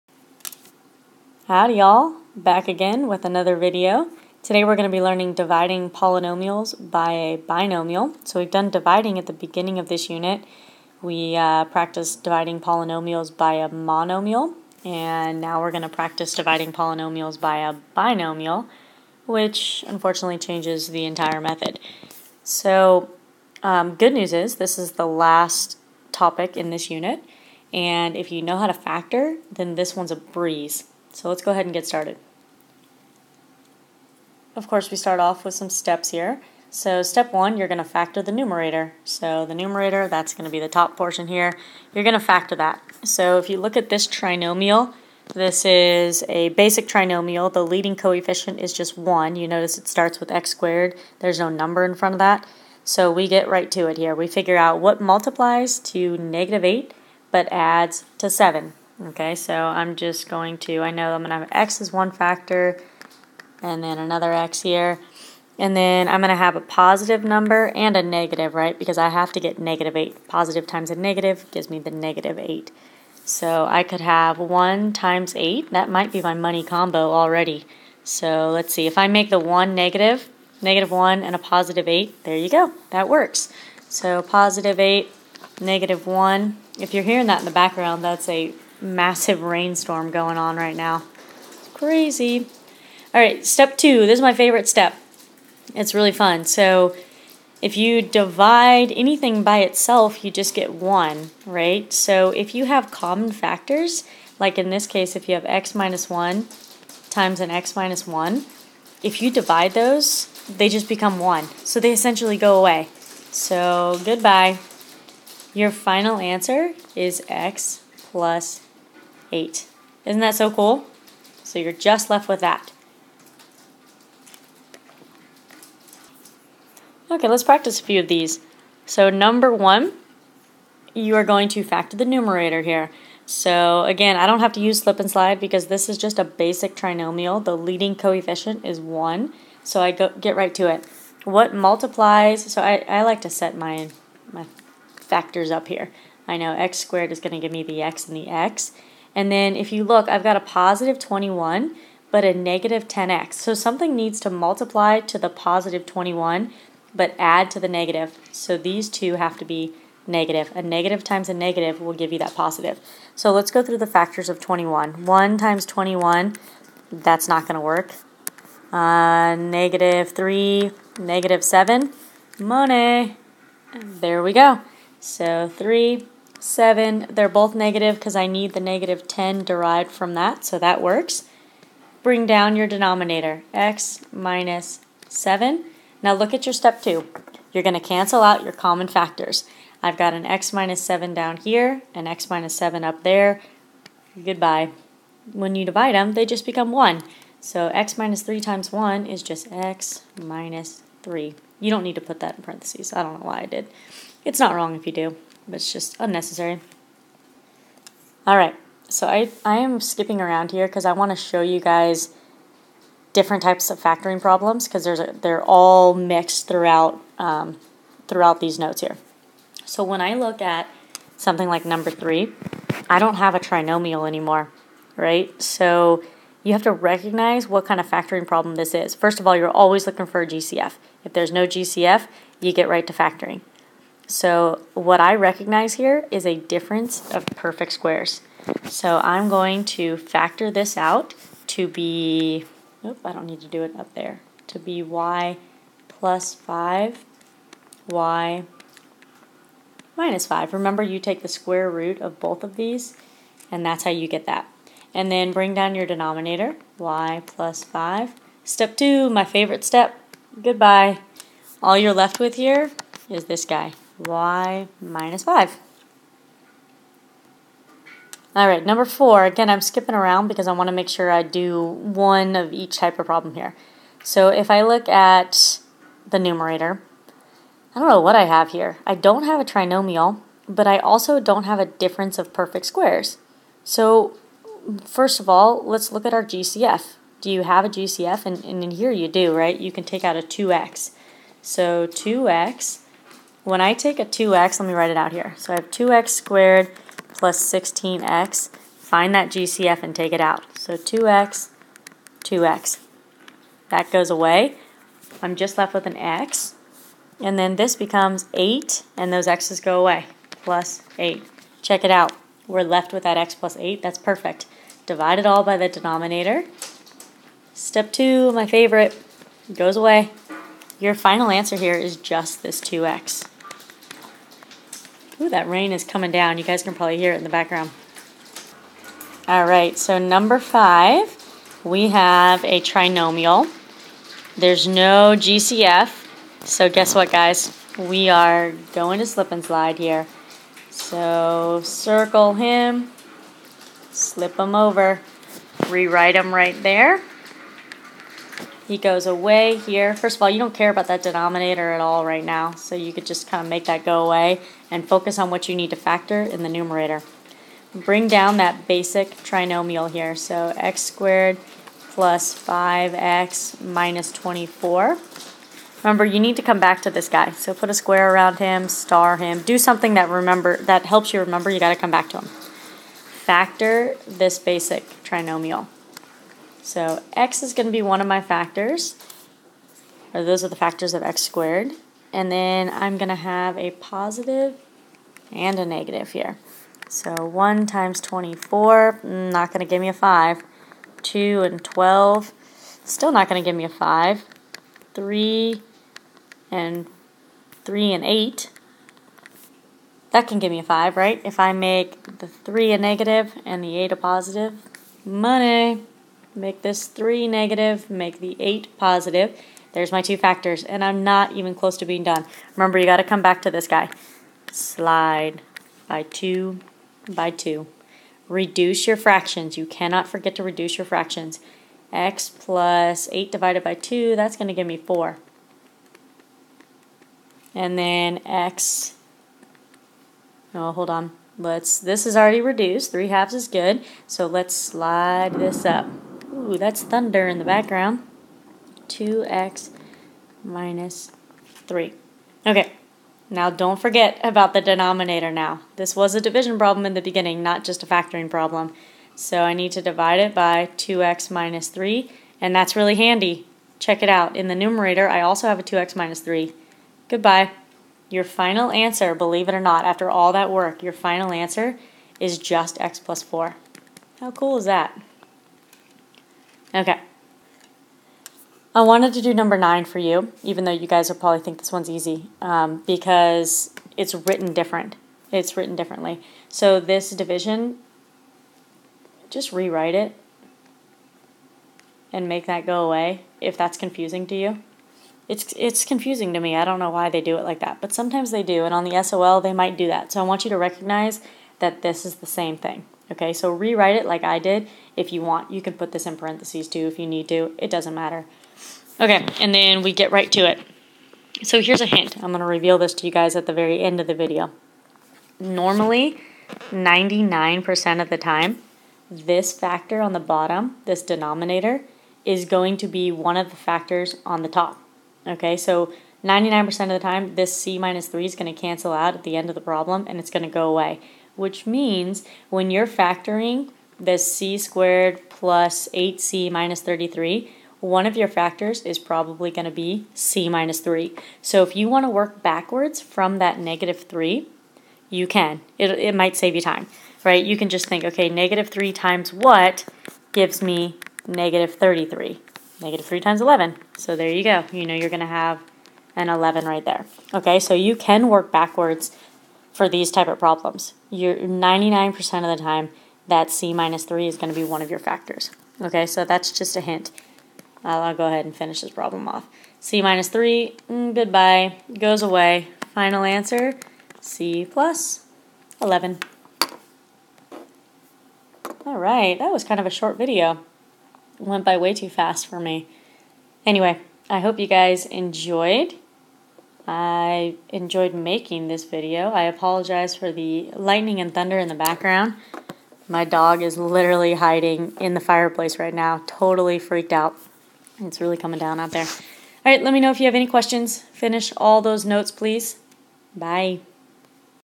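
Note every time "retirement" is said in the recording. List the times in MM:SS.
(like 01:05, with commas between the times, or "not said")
not said.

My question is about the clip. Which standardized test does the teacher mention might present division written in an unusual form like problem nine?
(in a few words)
SOL.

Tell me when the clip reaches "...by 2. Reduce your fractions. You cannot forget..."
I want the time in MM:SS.
06:57.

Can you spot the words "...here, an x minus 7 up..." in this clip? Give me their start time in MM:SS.
03:11.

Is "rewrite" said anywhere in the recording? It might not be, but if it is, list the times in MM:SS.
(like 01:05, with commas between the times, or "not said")
05:45, 07:59, 08:13.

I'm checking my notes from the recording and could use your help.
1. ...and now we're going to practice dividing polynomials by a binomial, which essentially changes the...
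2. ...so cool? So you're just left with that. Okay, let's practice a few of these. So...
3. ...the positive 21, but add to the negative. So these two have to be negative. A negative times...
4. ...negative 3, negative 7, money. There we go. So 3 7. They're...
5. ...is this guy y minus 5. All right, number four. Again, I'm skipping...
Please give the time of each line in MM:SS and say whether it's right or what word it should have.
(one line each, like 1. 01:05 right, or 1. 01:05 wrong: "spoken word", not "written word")
1. 00:14 wrong: "unfortunately", not "essentially"
2. 02:00 right
3. 02:35 right
4. 02:49 right
5. 04:23 right.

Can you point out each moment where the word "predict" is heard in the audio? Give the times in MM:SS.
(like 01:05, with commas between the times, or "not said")
not said.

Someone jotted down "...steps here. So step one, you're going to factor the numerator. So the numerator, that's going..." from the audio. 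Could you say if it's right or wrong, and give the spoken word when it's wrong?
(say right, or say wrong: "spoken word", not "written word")
right.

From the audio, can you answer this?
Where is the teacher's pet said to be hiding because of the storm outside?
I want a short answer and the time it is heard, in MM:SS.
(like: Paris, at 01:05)
the fireplace, at 09:45.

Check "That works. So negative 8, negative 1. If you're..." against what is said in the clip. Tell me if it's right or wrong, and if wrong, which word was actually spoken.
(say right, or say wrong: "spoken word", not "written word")
wrong: "positive", not "negative".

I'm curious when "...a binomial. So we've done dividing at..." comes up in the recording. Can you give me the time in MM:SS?
00:07.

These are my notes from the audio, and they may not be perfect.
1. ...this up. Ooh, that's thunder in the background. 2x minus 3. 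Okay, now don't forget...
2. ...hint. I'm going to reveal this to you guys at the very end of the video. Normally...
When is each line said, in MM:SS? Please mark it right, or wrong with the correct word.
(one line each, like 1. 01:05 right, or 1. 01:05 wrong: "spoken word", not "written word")
1. 07:15 right
2. 08:21 right.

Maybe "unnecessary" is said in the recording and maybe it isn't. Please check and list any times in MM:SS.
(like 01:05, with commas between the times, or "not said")
03:25.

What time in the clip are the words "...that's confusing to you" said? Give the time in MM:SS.
08:03.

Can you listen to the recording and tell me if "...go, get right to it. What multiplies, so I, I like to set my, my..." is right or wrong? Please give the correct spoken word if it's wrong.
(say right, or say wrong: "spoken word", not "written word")
right.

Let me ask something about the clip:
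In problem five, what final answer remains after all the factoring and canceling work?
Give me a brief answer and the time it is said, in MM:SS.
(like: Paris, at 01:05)
x + 4, at 07:42.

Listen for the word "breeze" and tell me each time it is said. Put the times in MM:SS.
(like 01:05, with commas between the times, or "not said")
00:30.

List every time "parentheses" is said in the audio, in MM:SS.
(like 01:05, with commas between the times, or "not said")
03:22, 08:16.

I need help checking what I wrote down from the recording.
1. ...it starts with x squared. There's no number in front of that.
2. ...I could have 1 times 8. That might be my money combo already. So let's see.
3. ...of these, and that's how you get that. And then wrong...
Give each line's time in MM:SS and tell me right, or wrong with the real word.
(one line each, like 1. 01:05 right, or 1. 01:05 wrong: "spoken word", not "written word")
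1. 00:49 right
2. 01:13 right
3. 04:12 wrong: "bring", not "wrong".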